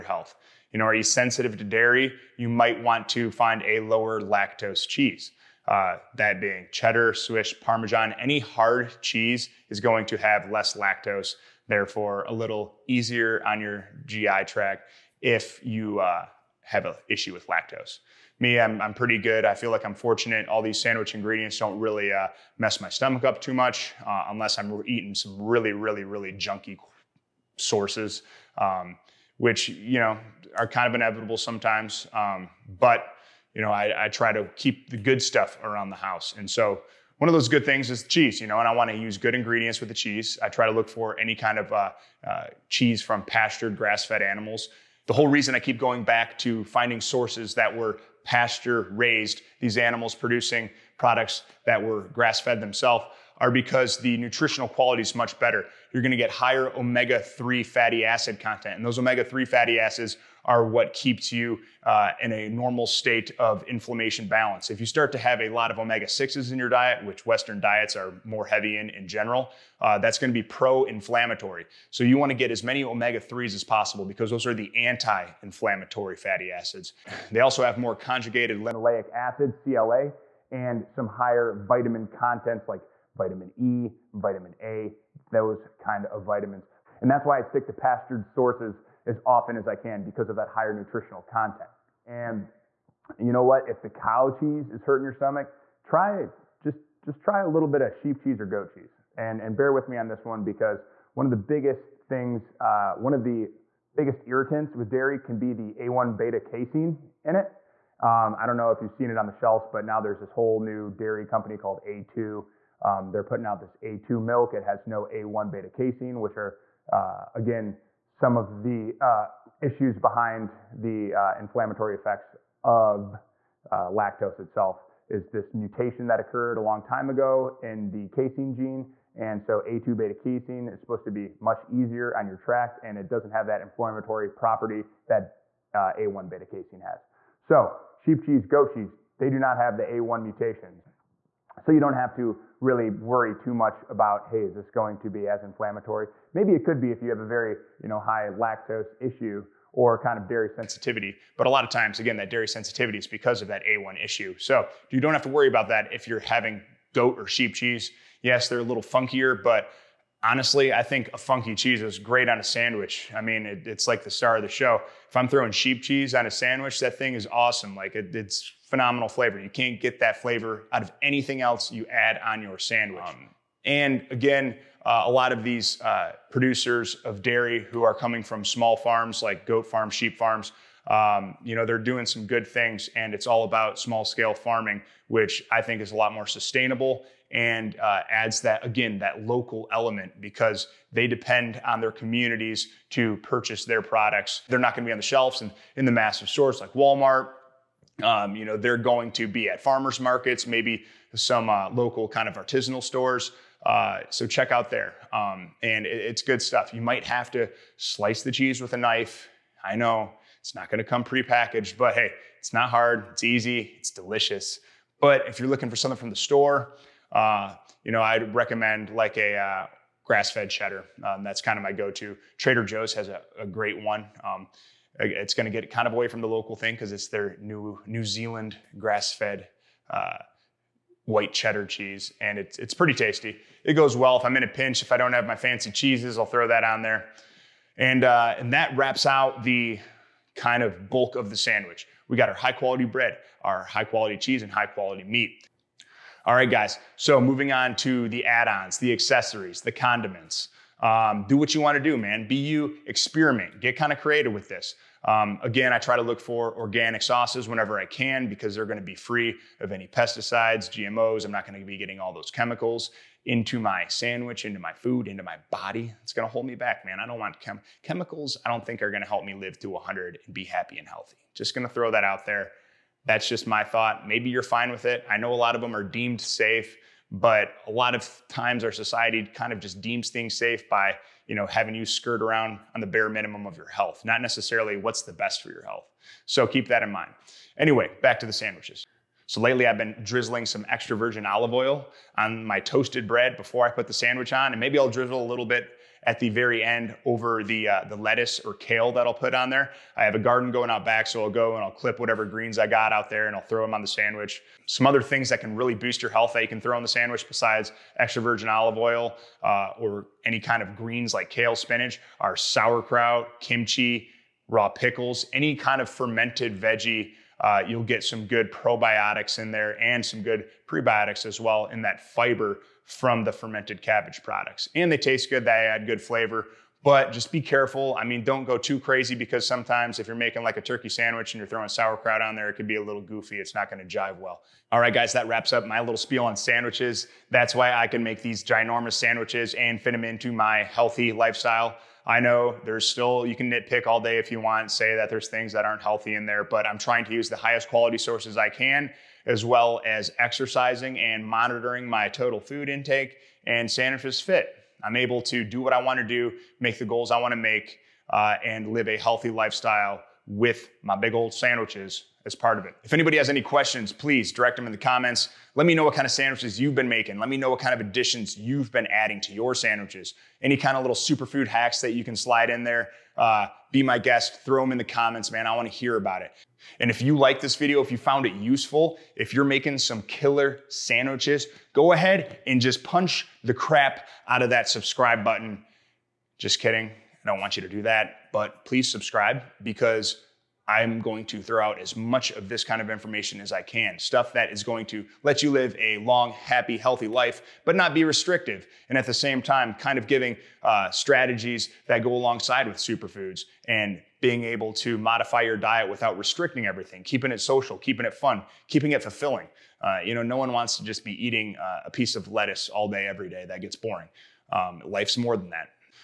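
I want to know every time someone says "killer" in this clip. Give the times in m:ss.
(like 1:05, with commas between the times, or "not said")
6:20.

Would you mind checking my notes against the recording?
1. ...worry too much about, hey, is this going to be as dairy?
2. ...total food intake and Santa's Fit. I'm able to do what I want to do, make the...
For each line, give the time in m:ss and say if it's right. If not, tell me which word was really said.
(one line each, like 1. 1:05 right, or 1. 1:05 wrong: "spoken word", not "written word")
1. 2:23 wrong: "inflammatory", not "dairy"
2. 5:52 right.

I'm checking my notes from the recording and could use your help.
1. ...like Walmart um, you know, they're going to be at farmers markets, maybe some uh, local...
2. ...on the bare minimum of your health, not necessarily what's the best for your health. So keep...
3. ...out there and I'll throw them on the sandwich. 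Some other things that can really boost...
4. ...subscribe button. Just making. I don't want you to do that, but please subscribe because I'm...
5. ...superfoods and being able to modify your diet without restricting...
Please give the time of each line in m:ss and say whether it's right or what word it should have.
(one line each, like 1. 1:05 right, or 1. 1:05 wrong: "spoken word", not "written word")
1. 3:16 right
2. 4:42 right
3. 5:02 right
4. 6:24 wrong: "kidding", not "making"
5. 6:42 right.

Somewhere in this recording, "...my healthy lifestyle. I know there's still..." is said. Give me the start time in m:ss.
5:40.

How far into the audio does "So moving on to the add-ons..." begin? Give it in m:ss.
4:06.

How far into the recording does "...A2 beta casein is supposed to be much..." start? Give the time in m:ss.
2:09.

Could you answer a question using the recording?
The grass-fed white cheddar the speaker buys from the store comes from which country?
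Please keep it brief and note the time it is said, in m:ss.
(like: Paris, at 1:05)
New Zealand, at 3:47.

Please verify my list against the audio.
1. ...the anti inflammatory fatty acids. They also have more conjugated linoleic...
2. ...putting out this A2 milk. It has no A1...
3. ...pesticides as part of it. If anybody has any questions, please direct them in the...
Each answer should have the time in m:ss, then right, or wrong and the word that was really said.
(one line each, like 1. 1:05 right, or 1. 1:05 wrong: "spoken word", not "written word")
1. 1:14 right
2. 1:53 right
3. 6:01 wrong: "sandwiches", not "pesticides".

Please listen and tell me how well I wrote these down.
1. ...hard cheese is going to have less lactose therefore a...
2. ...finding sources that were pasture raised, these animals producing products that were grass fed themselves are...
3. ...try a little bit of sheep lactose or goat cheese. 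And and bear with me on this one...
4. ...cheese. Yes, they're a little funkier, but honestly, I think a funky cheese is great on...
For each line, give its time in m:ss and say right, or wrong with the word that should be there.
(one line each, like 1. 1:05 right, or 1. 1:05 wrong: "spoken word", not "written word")
1. 0:08 right
2. 0:46 right
3. 1:37 wrong: "cheese", not "lactose"
4. 2:37 right.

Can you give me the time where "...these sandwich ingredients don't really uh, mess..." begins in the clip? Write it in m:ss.
0:20.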